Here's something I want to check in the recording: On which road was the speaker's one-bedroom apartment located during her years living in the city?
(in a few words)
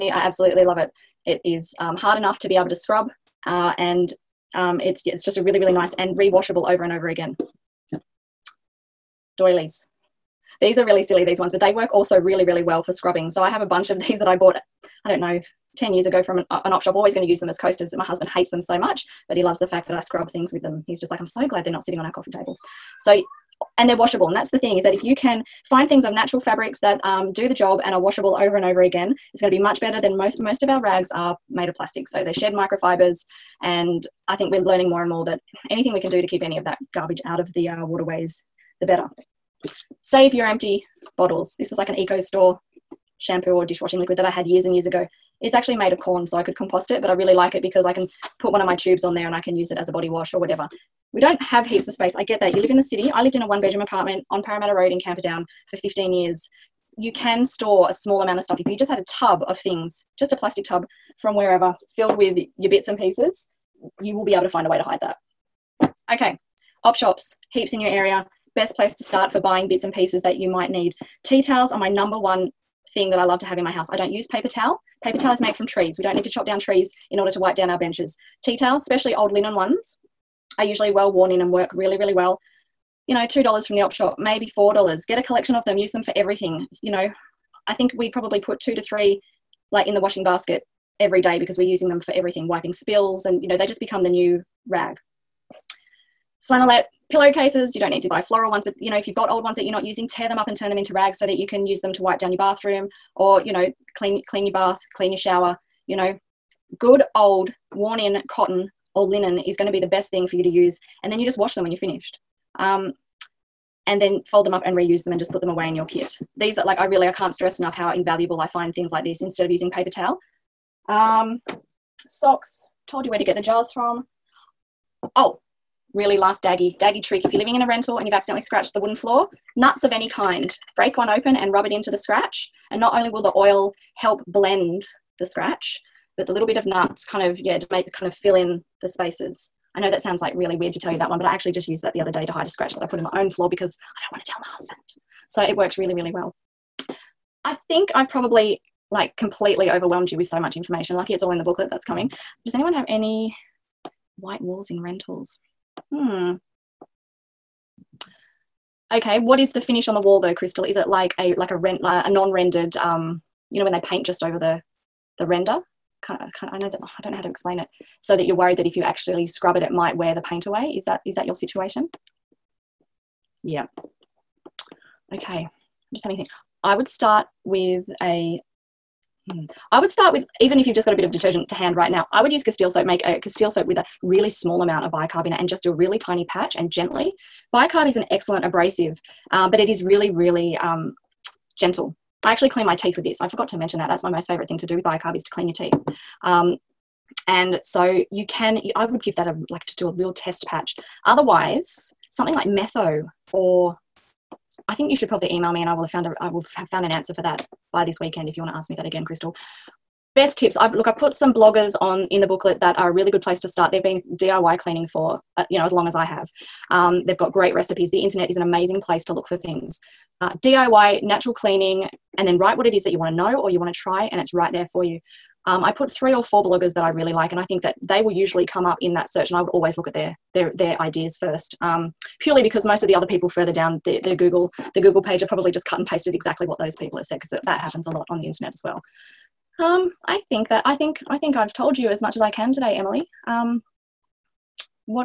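Parramatta Road.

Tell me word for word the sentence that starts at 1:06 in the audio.
Okay, op shops, heaps in your area best place to start for buying bits and pieces that you might need.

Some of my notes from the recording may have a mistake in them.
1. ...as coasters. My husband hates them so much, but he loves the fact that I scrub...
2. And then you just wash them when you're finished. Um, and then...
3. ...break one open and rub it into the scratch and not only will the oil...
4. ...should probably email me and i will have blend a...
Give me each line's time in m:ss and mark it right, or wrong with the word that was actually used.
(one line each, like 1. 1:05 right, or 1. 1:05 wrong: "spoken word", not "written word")
1. 0:17 right
2. 1:51 right
3. 2:10 right
4. 3:24 wrong: "found", not "blend".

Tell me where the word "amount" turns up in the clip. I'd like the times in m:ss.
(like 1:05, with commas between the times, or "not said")
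0:58, 3:04.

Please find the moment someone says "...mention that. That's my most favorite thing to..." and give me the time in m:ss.
3:13.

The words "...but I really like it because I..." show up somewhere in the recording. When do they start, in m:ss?
0:47.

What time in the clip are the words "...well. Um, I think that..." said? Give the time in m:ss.
3:58.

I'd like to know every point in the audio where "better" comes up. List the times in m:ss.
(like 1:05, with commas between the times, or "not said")
0:29, 0:38.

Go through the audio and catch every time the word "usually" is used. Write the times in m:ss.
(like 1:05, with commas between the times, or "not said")
1:20, 3:48.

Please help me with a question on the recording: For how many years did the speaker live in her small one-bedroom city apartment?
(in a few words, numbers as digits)
15.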